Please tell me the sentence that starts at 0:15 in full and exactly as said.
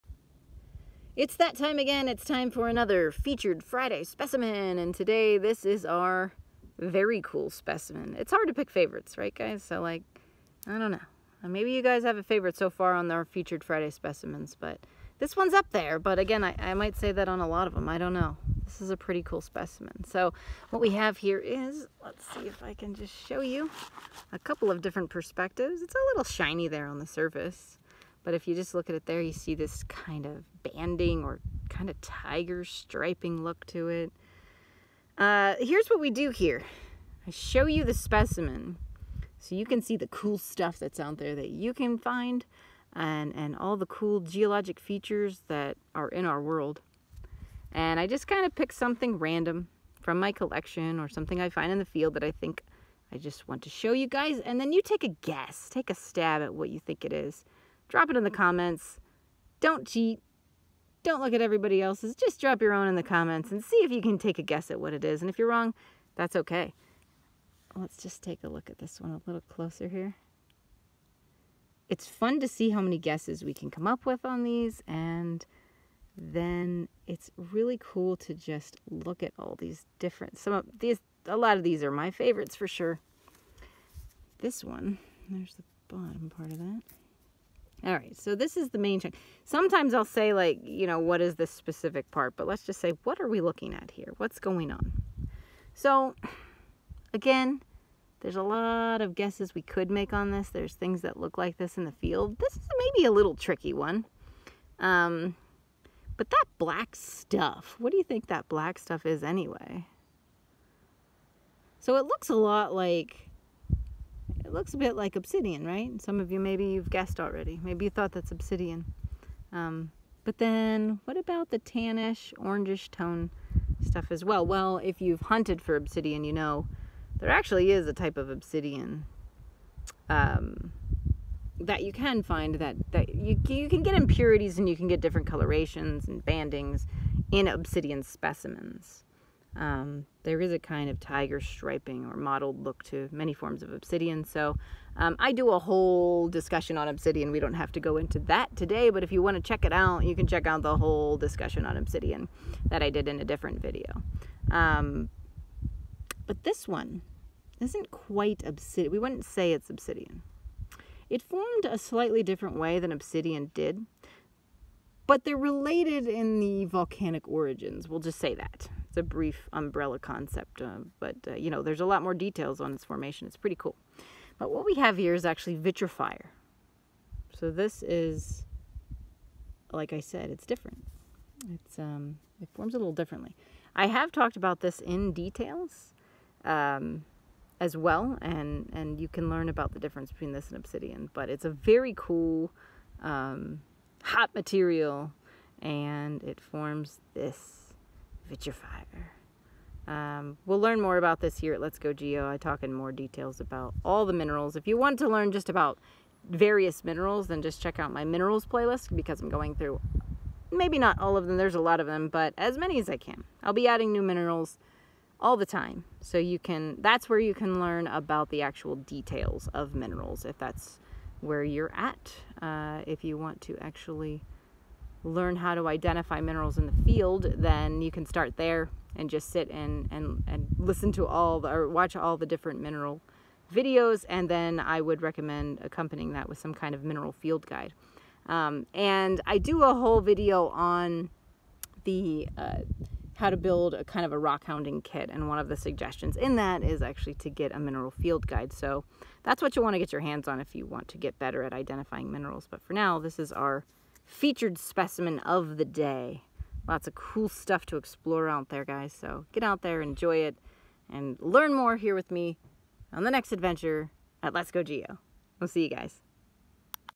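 But again, I, I might say that on a lot of them.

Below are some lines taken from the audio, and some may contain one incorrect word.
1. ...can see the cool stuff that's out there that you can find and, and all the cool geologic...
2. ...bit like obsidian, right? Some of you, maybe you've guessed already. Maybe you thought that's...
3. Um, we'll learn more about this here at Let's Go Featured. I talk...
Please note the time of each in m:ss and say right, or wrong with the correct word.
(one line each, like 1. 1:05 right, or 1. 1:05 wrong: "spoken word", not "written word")
1. 0:39 right
2. 1:54 right
3. 3:19 wrong: "Geo", not "Featured".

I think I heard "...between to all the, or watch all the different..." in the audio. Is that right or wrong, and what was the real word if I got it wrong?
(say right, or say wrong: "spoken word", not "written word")
wrong: "listen", not "between".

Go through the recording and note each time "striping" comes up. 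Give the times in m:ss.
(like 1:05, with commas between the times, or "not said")
0:32, 2:21.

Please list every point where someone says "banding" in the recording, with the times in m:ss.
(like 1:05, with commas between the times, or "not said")
0:30, 2:16.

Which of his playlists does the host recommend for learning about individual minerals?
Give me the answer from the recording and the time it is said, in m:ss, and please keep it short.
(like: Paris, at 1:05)
minerals playlist, at 3:28.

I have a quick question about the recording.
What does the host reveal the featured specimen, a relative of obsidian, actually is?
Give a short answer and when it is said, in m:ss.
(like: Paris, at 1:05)
vitrophyre, at 2:55.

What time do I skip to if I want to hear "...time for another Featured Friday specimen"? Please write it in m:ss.
0:02.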